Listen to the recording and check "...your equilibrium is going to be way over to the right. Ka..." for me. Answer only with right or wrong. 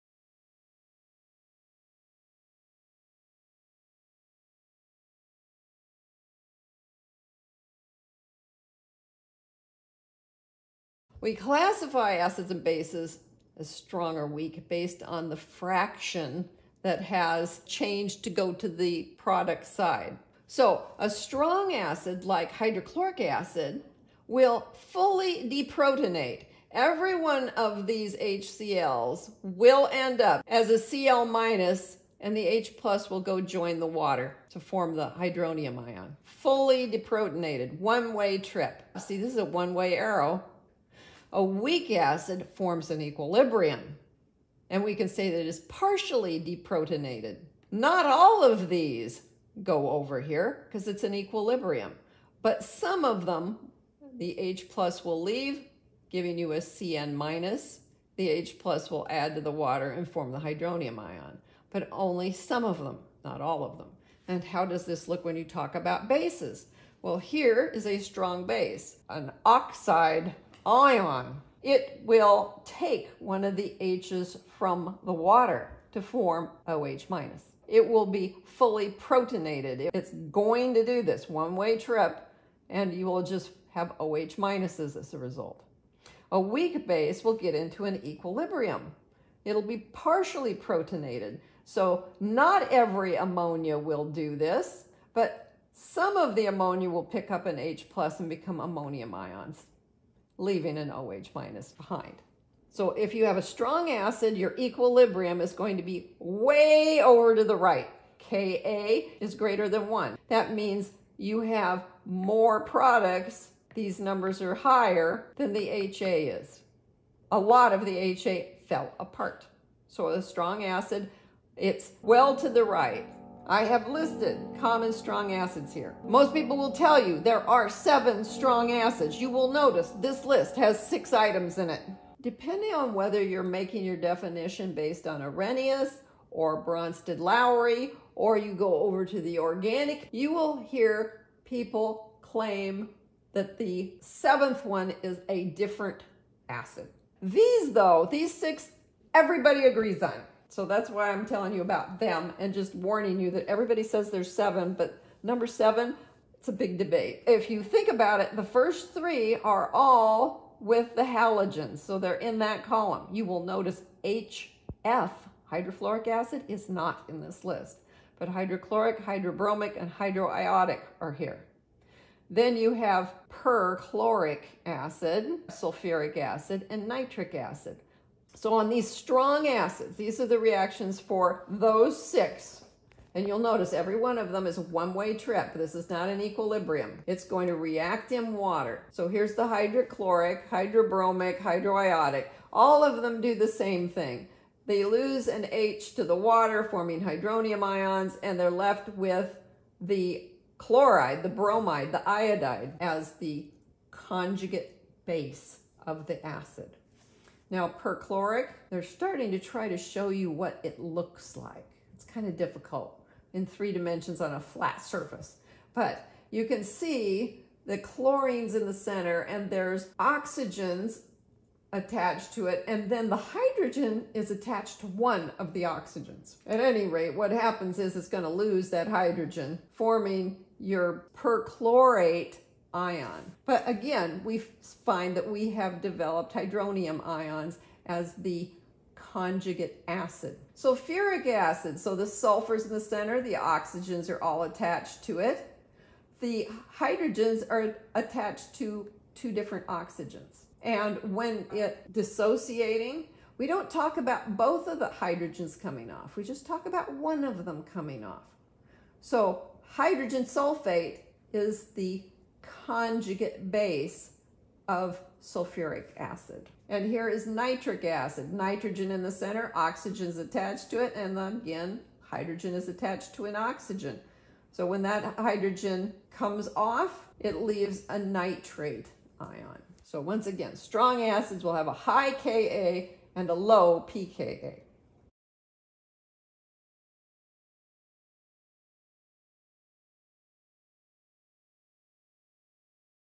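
right.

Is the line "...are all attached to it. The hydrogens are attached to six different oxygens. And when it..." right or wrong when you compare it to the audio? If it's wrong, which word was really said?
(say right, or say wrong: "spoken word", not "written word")
wrong: "two", not "six".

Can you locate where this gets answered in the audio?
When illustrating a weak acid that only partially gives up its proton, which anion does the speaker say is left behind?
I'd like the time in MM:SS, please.
00:56.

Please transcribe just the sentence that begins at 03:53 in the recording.
But again, we find that we have developed hydronium ions as the conjugate acid.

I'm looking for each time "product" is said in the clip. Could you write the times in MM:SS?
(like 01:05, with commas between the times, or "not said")
00:19, 01:52.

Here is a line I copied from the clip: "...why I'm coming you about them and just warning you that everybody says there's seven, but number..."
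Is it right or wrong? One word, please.
wrong.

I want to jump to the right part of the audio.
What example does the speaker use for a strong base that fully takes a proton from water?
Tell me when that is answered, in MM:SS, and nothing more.
01:09.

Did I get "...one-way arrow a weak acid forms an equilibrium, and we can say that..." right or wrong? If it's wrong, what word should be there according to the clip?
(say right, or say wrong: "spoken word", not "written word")
right.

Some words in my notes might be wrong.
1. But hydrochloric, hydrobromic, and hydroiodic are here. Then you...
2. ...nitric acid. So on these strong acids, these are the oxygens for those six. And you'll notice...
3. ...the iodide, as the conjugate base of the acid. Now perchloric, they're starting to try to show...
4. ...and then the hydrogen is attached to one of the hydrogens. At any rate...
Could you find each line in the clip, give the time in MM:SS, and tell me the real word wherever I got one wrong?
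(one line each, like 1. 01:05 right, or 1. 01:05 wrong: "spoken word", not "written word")
1. 02:48 right
2. 02:56 wrong: "reactions", not "oxygens"
3. 03:21 right
4. 03:42 wrong: "oxygens", not "hydrogens".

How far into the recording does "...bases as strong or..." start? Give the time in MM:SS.
00:12.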